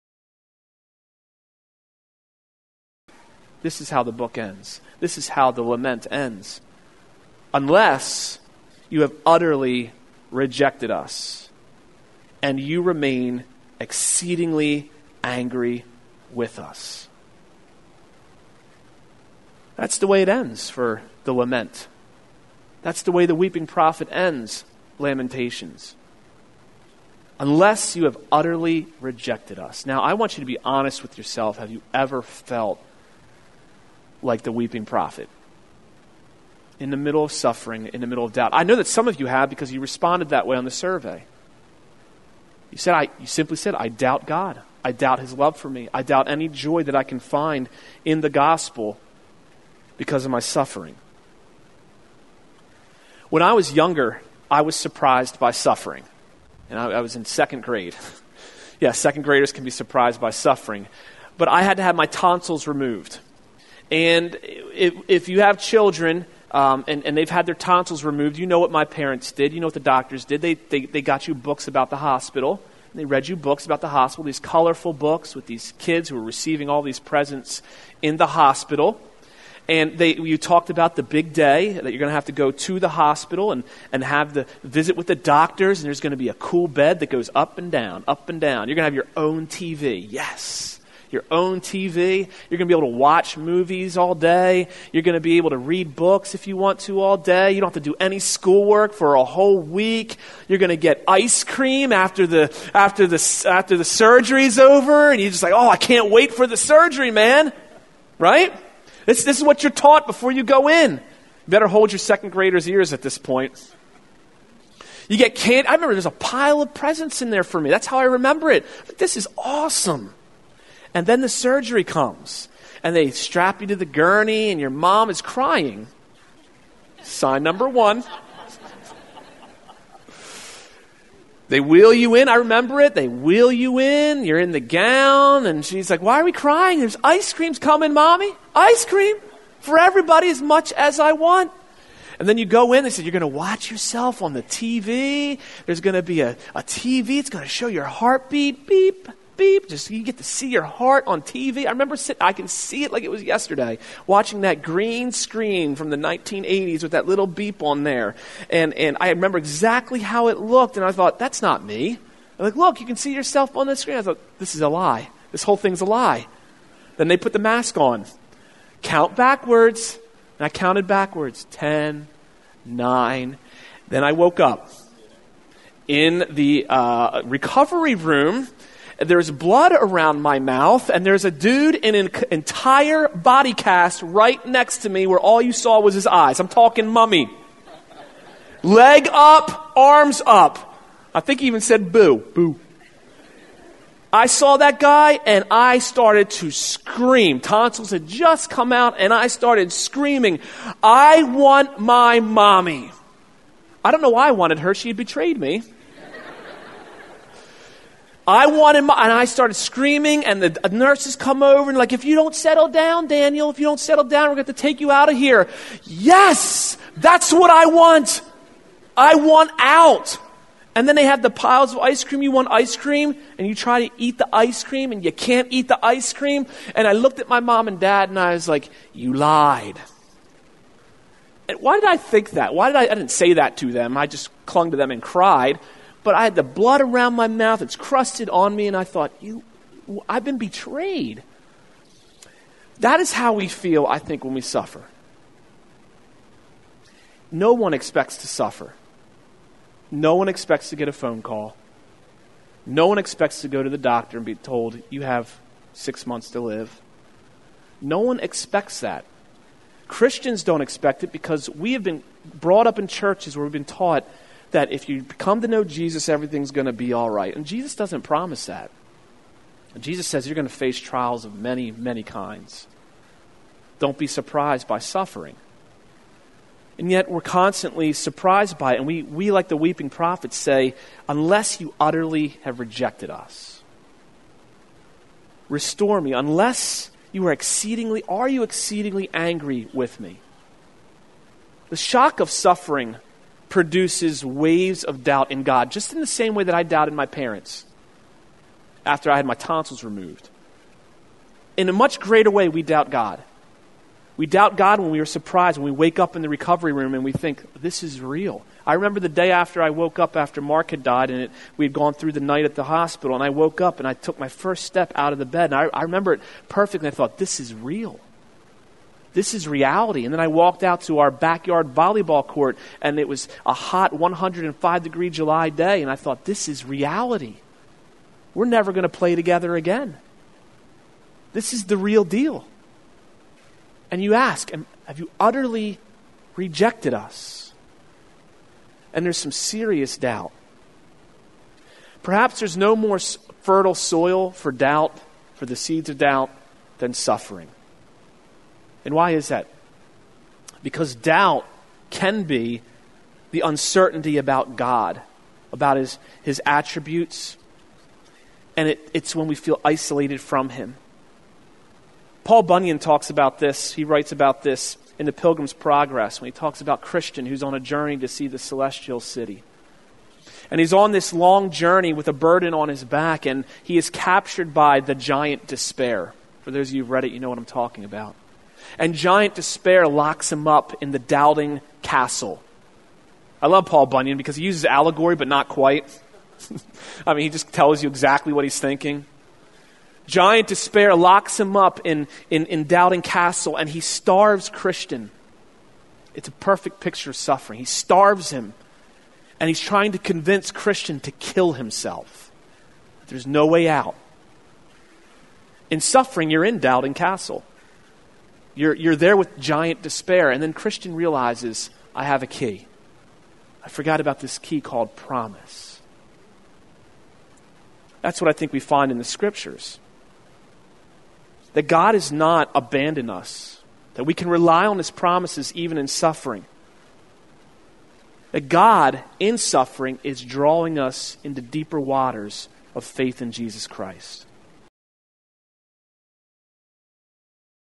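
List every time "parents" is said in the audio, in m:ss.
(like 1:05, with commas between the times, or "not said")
1:08, 4:57.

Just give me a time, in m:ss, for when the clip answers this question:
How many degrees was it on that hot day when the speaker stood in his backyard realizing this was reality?
5:23.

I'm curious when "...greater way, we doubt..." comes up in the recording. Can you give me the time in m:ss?
5:01.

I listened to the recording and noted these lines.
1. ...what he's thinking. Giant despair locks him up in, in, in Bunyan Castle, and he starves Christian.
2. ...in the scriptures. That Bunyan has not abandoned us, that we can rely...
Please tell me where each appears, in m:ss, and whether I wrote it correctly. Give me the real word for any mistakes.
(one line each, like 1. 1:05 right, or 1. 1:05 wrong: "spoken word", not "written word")
1. 6:28 wrong: "Doubting", not "Bunyan"
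2. 6:58 wrong: "God", not "Bunyan".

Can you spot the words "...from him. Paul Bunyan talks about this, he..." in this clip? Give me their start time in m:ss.
6:00.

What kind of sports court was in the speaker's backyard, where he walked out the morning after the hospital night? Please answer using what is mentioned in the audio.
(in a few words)
Volleyball court.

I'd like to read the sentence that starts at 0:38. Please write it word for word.
I know that some of you have because you responded that way on the survey.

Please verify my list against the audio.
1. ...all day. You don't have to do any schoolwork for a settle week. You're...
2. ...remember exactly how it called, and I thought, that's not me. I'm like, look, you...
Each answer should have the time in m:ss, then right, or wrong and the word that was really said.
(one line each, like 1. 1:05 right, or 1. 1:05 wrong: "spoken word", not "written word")
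1. 1:37 wrong: "whole", not "settle"
2. 2:39 wrong: "looked", not "called".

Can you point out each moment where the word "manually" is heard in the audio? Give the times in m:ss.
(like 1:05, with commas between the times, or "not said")
not said.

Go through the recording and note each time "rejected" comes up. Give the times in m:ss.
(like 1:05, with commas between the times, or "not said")
0:10, 0:28, 4:42, 5:36.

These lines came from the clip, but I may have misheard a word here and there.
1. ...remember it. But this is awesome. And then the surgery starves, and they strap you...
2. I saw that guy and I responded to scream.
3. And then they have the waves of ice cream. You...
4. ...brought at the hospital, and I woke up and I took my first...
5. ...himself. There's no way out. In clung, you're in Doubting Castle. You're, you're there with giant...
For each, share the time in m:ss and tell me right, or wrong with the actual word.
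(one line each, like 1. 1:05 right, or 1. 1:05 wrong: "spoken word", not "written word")
1. 1:58 wrong: "comes", not "starves"
2. 3:14 wrong: "started", not "responded"
3. 3:40 wrong: "piles", not "waves"
4. 5:12 wrong: "night", not "brought"
5. 6:41 wrong: "suffering", not "clung".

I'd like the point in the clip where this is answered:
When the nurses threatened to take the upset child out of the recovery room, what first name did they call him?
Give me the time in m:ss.
3:33.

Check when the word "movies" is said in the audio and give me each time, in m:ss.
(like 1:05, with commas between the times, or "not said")
1:33.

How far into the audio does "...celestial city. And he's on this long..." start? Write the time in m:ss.
6:08.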